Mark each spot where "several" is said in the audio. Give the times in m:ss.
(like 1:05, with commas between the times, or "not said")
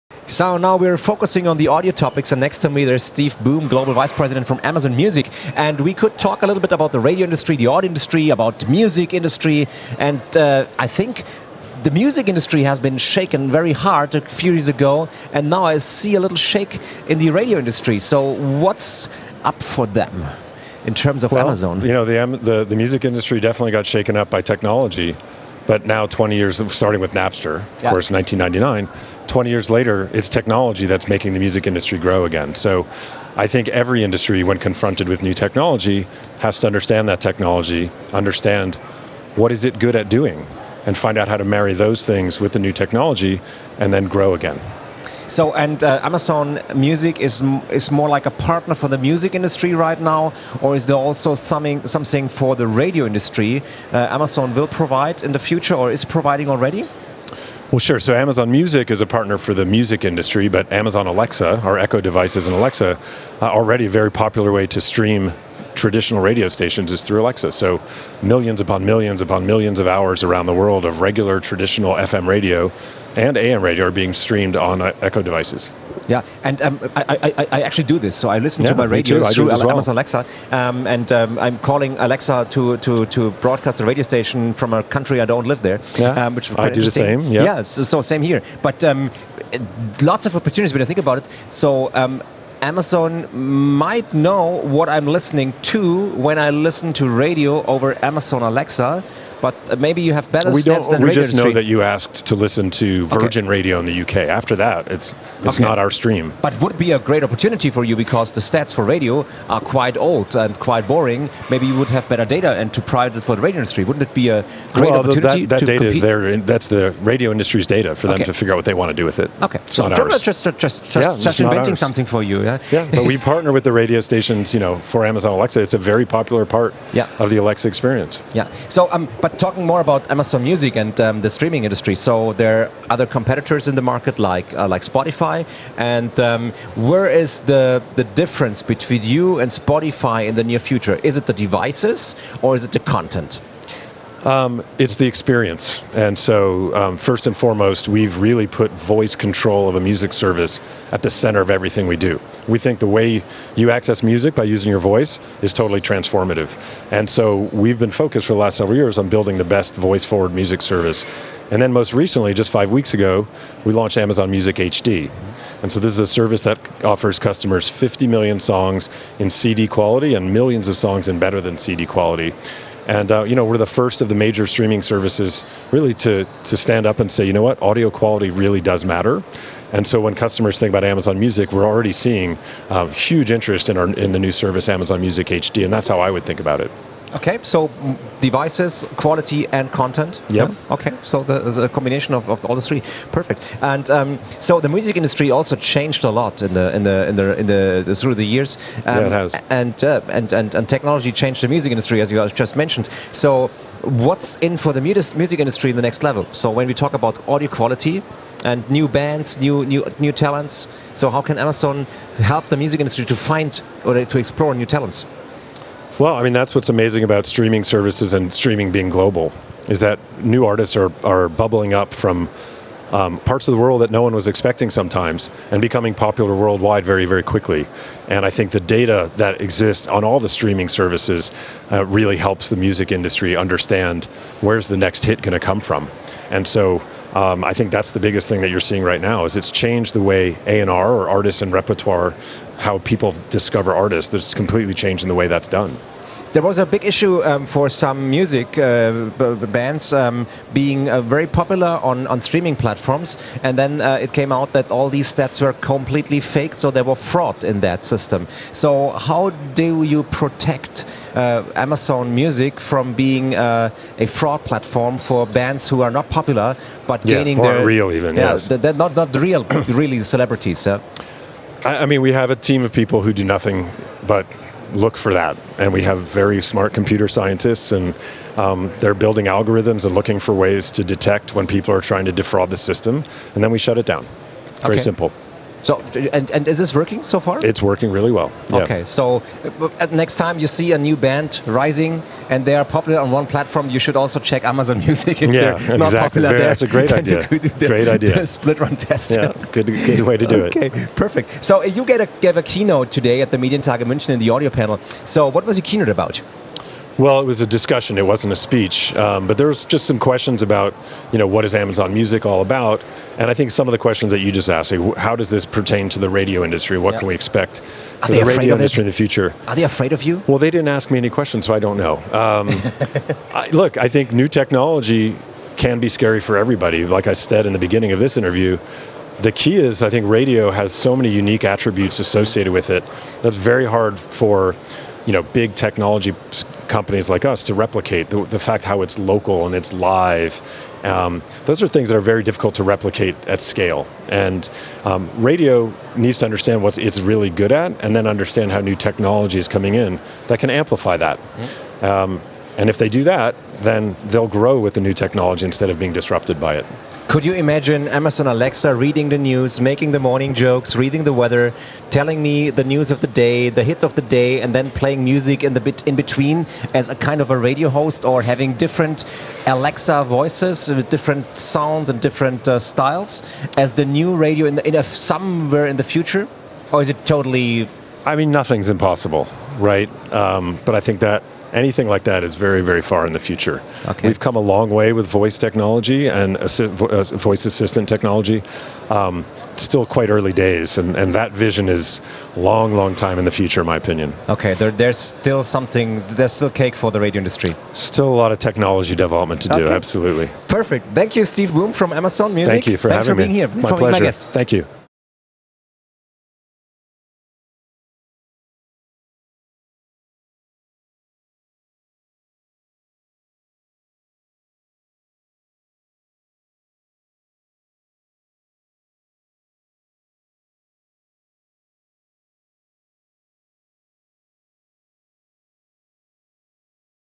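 2:38.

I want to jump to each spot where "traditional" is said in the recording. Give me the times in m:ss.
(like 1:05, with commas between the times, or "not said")
1:05, 1:11.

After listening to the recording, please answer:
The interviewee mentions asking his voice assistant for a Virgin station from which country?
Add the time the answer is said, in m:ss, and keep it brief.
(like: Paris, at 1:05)
UK, at 1:44.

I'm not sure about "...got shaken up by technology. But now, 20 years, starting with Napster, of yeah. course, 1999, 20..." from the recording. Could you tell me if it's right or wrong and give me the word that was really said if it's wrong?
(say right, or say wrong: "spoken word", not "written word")
right.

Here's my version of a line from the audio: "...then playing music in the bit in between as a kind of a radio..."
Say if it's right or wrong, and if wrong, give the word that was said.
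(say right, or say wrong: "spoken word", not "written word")
right.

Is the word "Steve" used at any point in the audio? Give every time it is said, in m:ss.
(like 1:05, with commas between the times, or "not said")
0:03, 6:41.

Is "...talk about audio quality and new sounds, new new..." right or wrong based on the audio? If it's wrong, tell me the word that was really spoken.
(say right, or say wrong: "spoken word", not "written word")
wrong: "bands", not "sounds".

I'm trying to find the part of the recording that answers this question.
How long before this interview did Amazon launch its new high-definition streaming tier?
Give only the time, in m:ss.
2:42.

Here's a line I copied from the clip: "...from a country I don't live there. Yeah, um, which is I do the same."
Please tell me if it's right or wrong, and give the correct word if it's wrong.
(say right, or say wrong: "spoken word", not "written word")
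right.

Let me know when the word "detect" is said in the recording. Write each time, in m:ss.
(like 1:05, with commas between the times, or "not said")
4:40.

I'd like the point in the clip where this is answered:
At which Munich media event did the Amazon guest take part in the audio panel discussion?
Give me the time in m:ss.
5:03.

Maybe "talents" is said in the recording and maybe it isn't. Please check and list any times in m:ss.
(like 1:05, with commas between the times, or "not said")
3:30, 3:34.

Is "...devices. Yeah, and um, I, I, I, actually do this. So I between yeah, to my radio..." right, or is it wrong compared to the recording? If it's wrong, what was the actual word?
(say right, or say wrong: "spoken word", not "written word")
wrong: "listen", not "between".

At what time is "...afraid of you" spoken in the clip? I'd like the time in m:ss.
5:19.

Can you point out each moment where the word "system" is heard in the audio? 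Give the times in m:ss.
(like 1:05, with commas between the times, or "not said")
4:17, 4:42.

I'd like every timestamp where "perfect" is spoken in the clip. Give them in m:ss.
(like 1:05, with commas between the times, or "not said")
3:13, 5:00, 6:40.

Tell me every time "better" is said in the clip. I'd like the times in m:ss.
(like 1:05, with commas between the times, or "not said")
1:40, 1:52, 2:51.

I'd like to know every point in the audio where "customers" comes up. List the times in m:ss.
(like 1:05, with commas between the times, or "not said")
2:47, 3:00.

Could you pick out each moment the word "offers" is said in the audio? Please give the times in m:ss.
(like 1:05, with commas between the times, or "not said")
2:46.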